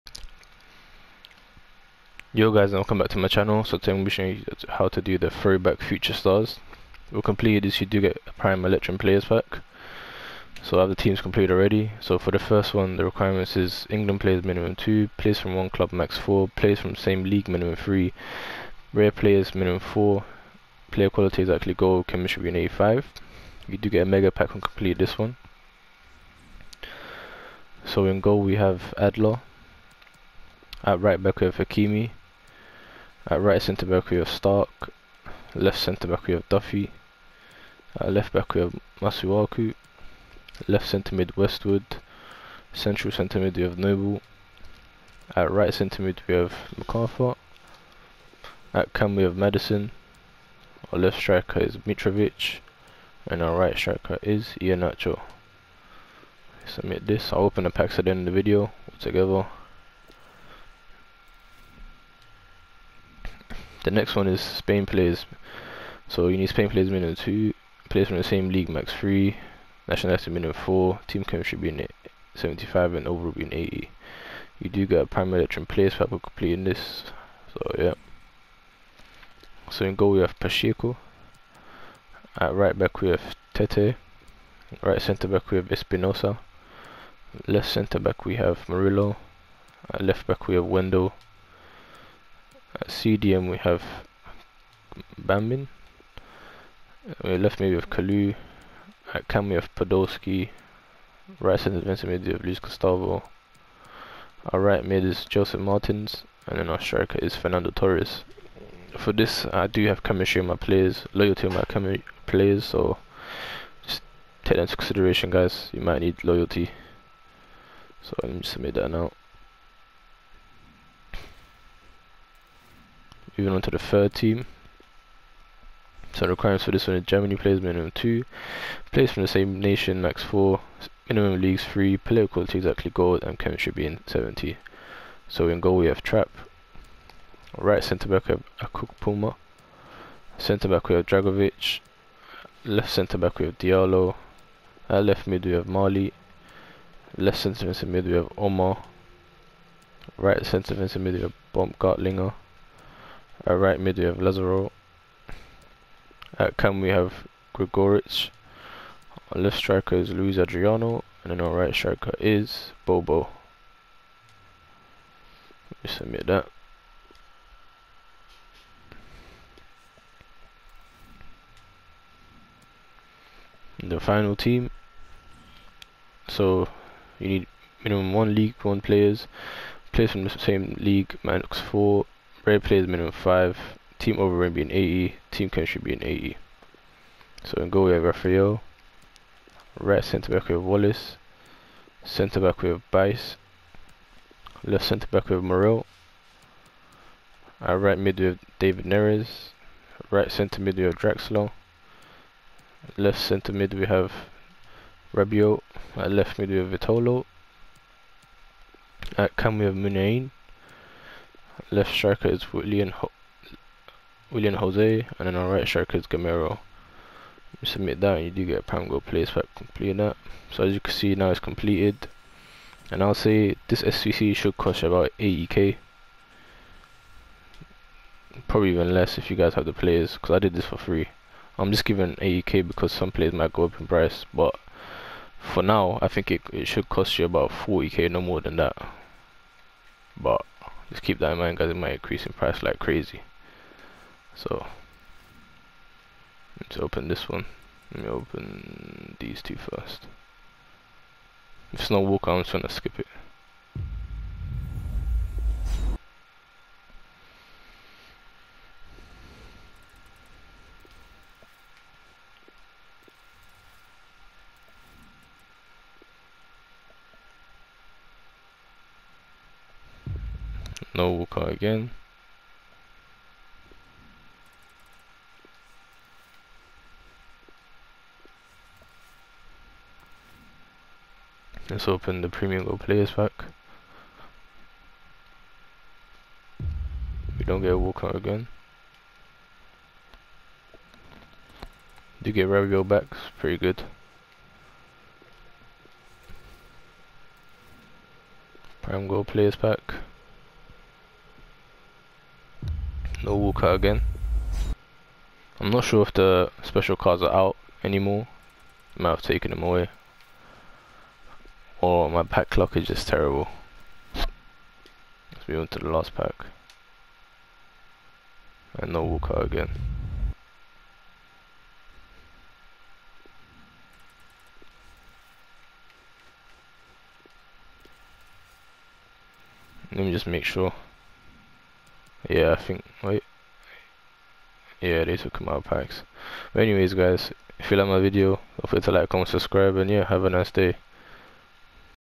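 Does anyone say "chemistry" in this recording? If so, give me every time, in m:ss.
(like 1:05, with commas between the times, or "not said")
0:22, 1:11, 1:50, 2:13.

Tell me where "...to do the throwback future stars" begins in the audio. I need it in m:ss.
0:04.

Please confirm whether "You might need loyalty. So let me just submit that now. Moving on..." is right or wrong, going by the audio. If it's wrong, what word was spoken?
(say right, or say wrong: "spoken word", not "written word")
right.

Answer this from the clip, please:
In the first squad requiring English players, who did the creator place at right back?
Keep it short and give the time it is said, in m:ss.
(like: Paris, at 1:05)
Hakimi, at 0:31.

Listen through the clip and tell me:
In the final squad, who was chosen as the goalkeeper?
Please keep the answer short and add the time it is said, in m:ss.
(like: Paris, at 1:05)
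Rafael, at 3:08.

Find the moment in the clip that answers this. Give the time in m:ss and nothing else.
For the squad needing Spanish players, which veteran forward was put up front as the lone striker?
1:47.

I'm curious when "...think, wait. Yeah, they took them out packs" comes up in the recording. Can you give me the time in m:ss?
5:32.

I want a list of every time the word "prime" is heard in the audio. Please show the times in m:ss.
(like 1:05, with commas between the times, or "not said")
0:08, 1:15, 3:38, 4:58.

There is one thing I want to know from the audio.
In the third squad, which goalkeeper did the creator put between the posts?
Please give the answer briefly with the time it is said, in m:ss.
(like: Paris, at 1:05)
Trapp, at 2:16.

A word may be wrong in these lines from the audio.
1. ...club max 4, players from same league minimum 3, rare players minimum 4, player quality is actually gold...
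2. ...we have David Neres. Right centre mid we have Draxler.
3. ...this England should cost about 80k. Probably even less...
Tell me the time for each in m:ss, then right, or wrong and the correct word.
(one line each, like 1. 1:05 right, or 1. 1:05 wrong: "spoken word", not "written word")
1. 0:15 right
2. 3:18 right
3. 3:43 wrong: "SBC", not "England".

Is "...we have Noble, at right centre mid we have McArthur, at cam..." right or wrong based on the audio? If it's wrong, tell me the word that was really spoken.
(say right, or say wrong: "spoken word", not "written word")
right.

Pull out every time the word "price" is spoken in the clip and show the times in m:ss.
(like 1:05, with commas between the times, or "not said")
3:53, 4:02.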